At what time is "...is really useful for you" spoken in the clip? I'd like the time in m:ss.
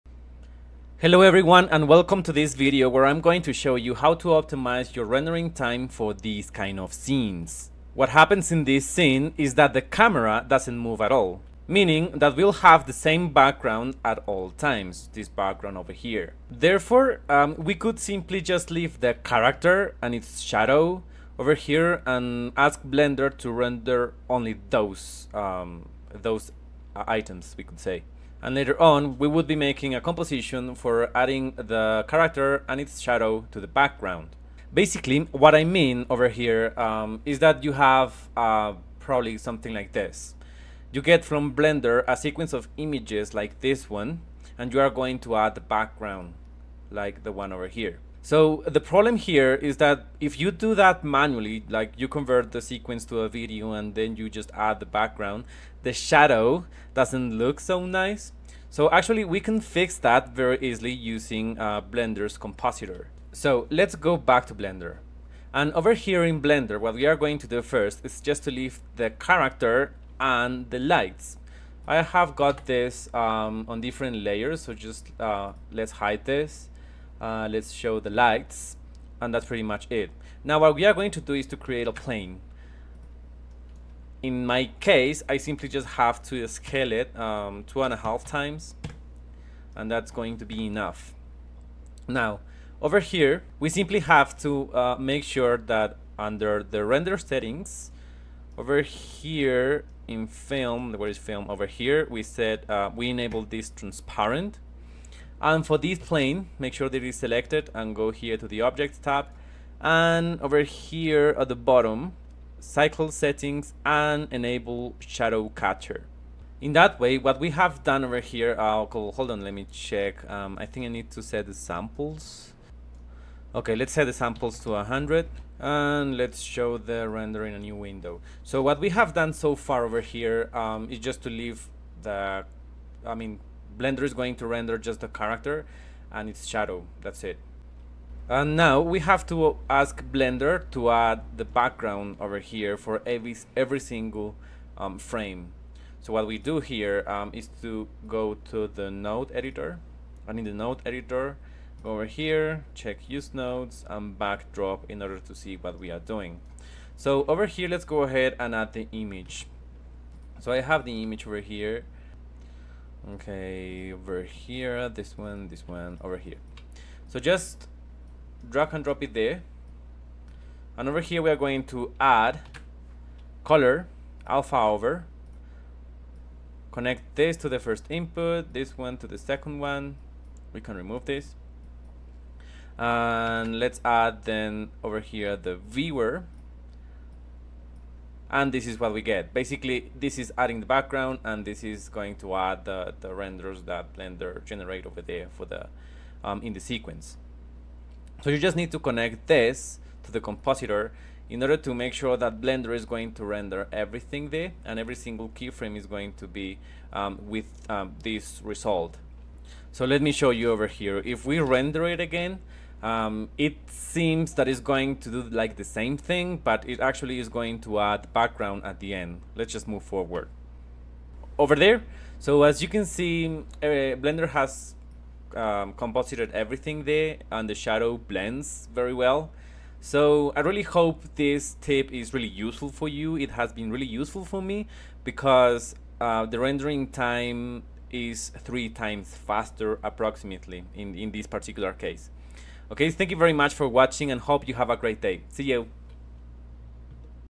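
3:51.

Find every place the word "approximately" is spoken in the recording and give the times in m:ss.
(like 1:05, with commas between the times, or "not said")
3:59.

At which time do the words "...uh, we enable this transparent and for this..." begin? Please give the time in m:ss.
1:42.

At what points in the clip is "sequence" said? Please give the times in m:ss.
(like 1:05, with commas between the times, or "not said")
0:42, 0:52, 3:16.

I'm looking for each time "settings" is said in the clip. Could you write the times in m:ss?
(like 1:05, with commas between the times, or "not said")
1:37, 1:53.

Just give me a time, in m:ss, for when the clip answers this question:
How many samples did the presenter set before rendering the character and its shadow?
2:04.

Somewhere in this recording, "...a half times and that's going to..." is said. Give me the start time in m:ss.
1:27.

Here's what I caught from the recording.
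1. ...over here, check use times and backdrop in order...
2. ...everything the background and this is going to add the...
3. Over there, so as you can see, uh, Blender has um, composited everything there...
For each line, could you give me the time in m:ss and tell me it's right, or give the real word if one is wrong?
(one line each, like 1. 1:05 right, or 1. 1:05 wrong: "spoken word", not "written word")
1. 2:31 wrong: "nodes", not "times"
2. 3:10 wrong: "adding", not "everything"
3. 3:41 right.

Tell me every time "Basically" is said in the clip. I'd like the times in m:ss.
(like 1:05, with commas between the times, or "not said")
0:34, 3:09.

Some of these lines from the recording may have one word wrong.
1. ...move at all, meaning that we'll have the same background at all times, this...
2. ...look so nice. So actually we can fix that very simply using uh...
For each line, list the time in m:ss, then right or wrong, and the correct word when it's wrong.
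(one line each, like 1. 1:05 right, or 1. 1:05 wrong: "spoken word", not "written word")
1. 0:10 right
2. 0:57 wrong: "easily", not "simply".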